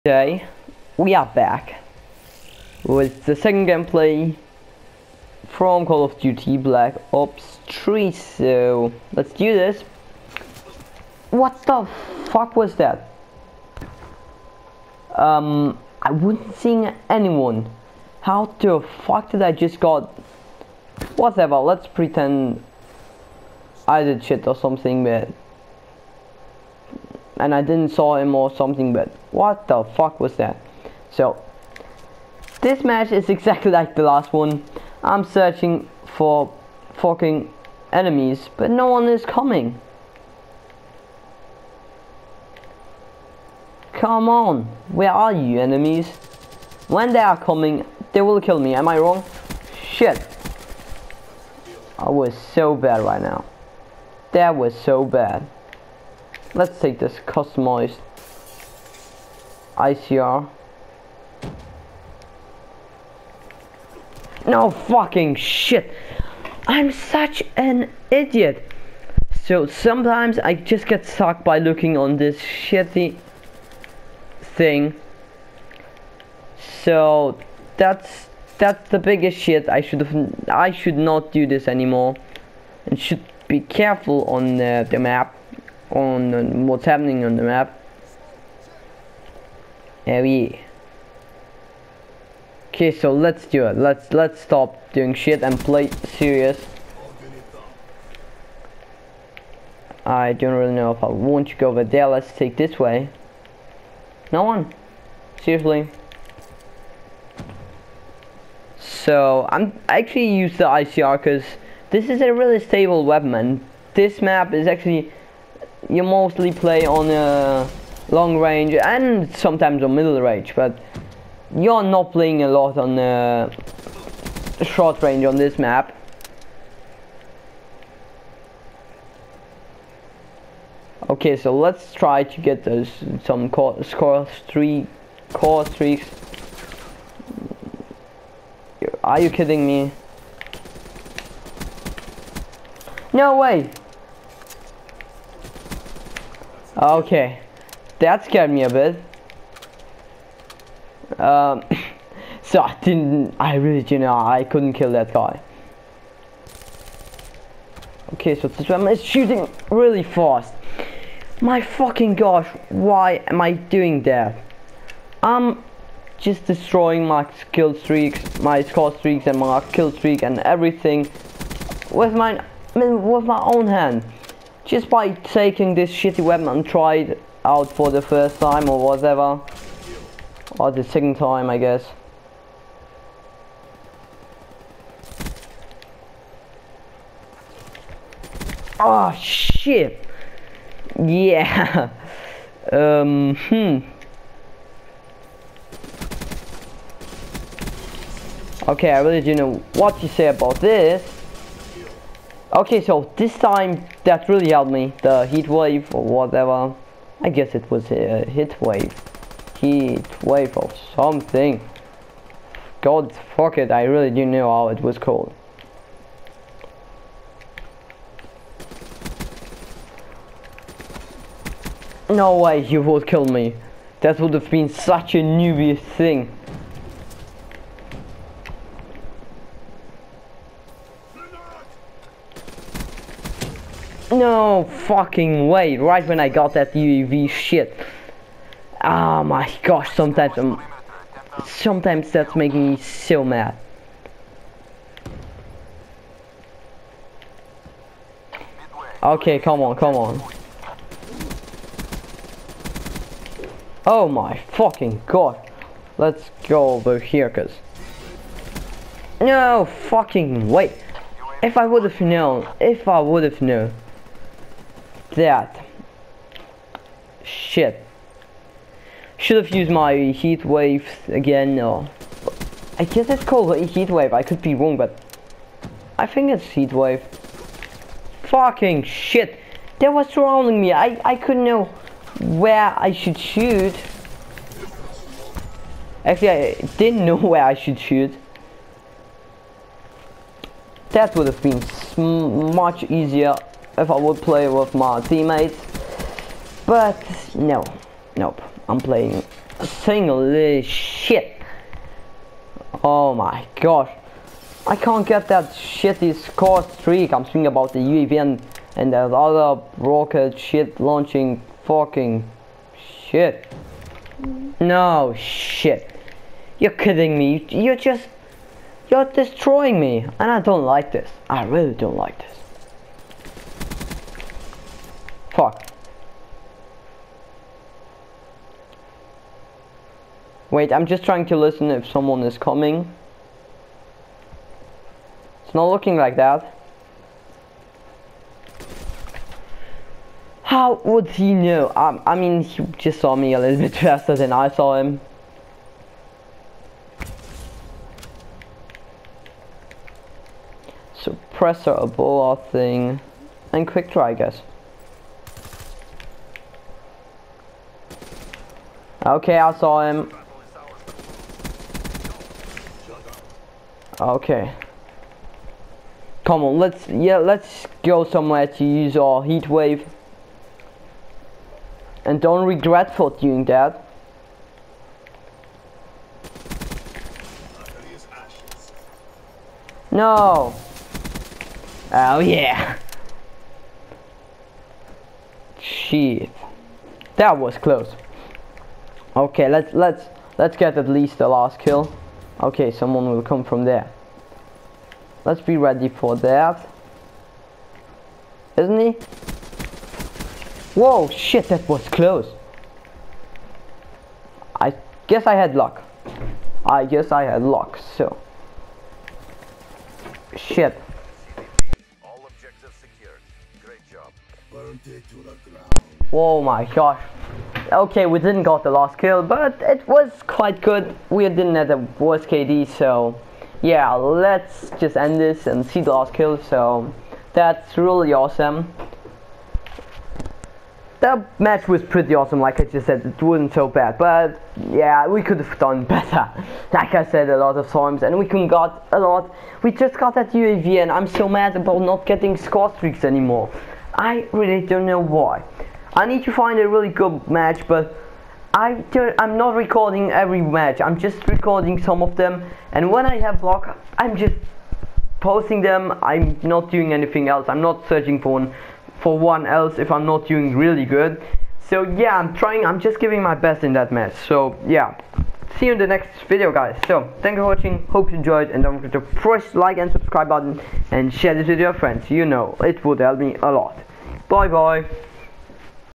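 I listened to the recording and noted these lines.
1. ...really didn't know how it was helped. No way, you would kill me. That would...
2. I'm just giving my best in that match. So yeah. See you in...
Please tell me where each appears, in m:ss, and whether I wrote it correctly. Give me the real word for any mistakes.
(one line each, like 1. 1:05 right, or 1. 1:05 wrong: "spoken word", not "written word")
1. 3:33 wrong: "called", not "helped"
2. 7:42 right.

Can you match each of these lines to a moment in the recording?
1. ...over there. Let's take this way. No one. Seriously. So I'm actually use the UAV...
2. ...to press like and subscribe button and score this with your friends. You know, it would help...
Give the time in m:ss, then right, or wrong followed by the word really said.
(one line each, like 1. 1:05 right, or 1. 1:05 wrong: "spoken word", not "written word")
1. 1:41 wrong: "ICR", not "UAV"
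2. 7:48 wrong: "share", not "score".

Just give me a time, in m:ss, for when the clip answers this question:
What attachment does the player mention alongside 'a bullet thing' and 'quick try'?
5:51.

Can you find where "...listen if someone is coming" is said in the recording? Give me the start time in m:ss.
5:31.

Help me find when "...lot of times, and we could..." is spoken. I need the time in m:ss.
7:17.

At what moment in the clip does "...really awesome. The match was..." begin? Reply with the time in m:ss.
7:07.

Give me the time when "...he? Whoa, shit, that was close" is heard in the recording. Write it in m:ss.
6:38.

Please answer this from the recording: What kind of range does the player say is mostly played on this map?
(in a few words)
Long range.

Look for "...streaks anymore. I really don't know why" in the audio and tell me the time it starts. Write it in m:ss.
7:22.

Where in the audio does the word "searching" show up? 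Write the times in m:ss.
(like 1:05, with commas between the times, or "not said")
0:35, 7:37.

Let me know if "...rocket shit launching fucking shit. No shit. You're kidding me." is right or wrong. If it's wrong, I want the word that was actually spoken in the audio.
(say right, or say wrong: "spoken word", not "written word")
right.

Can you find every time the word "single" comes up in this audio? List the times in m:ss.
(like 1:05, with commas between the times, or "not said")
4:59.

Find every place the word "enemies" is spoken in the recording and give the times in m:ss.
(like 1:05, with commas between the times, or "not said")
0:37, 0:45.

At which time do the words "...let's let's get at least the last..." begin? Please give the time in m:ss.
6:29.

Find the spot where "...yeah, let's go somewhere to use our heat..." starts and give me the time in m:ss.
6:06.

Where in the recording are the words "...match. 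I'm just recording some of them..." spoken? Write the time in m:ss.
7:30.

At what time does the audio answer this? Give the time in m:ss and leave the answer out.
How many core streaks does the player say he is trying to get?
2:14.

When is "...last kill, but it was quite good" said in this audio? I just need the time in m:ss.
6:58.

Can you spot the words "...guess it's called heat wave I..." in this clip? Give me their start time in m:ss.
4:32.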